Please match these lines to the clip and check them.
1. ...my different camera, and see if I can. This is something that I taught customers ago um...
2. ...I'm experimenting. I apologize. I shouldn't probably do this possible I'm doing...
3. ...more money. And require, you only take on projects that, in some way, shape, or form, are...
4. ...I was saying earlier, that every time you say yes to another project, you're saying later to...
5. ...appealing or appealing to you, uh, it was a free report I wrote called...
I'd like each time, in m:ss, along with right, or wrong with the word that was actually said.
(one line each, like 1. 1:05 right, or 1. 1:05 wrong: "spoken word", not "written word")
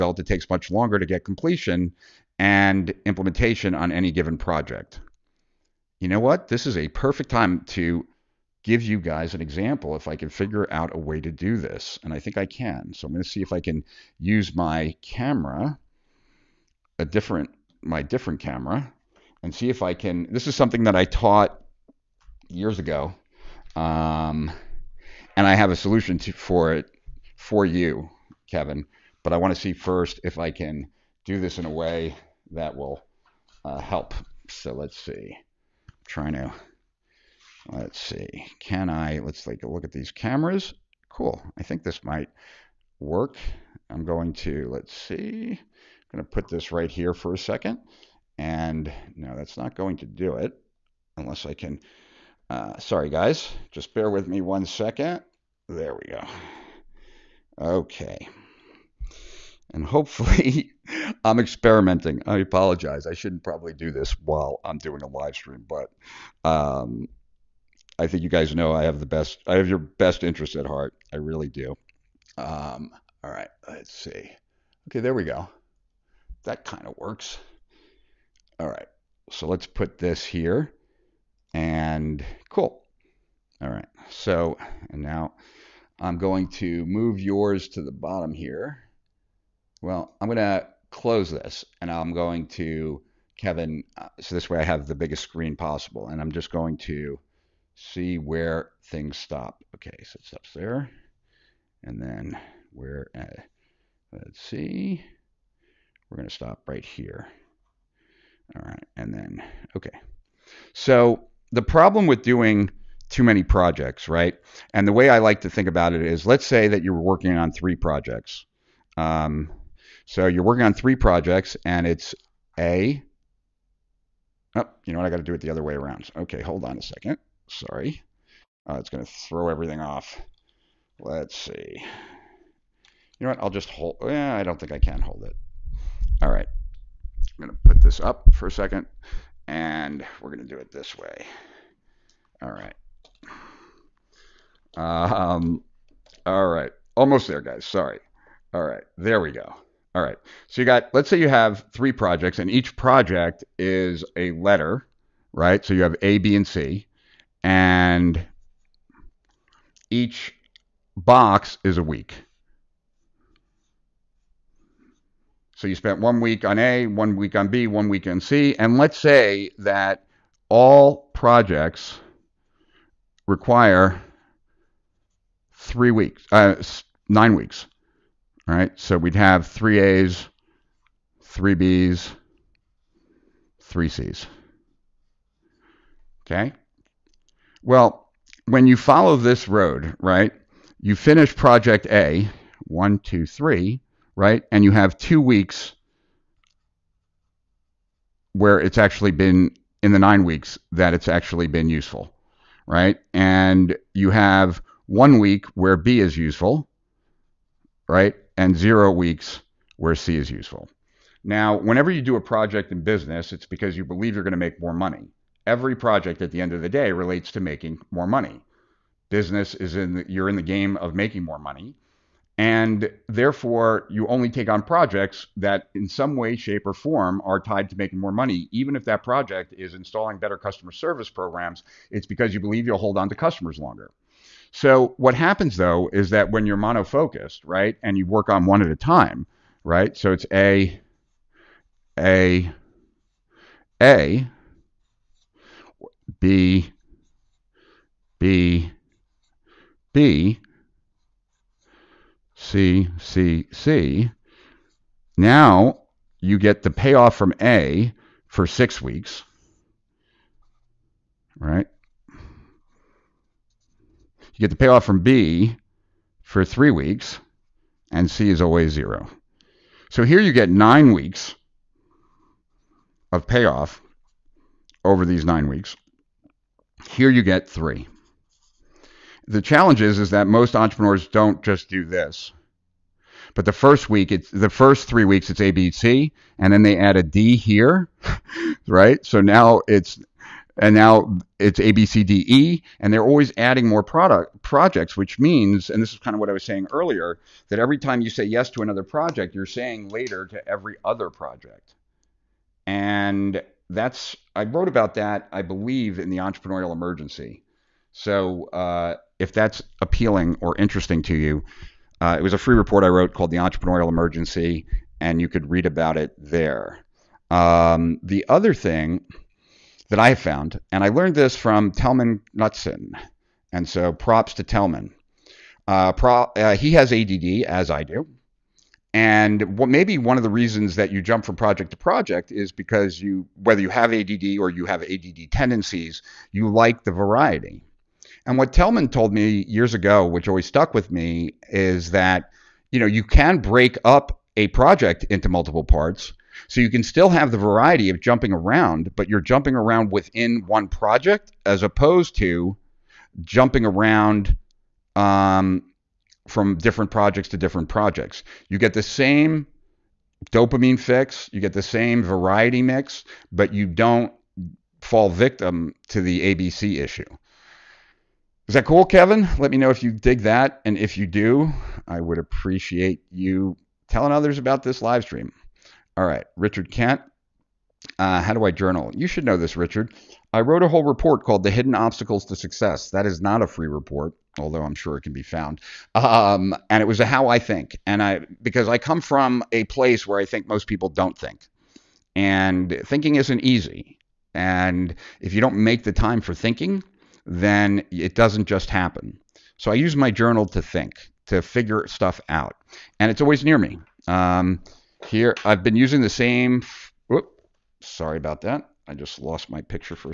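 1. 0:17 wrong: "years", not "customers"
2. 1:01 wrong: "while", not "possible"
3. 3:41 wrong: "therefore", not "require"
4. 4:56 right
5. 5:09 wrong: "interesting", not "appealing".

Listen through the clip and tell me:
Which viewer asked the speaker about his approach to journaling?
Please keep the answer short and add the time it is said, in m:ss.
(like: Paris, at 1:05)
Richard Kent, at 6:16.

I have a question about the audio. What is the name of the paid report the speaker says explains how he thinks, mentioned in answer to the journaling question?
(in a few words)
The Hidden Obstacles to Success.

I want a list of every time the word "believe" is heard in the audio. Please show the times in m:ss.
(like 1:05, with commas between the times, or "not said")
3:33, 3:52, 5:05.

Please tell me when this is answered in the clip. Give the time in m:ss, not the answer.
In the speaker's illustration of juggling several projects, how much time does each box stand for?
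2:39.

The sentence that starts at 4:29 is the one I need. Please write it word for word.
So here you get nine weeks of payoff over these nine weeks.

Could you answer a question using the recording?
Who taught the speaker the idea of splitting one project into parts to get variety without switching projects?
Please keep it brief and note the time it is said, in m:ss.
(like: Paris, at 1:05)
Tellman Knudson, at 5:21.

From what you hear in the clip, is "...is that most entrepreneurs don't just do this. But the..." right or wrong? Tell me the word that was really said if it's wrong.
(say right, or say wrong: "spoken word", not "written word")
right.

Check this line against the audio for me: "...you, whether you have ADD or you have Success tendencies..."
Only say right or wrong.
wrong.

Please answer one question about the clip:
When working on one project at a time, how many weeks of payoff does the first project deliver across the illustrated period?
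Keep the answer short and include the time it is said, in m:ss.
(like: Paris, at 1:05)
6 weeks, at 4:18.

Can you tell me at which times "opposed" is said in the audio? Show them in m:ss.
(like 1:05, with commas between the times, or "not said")
5:51.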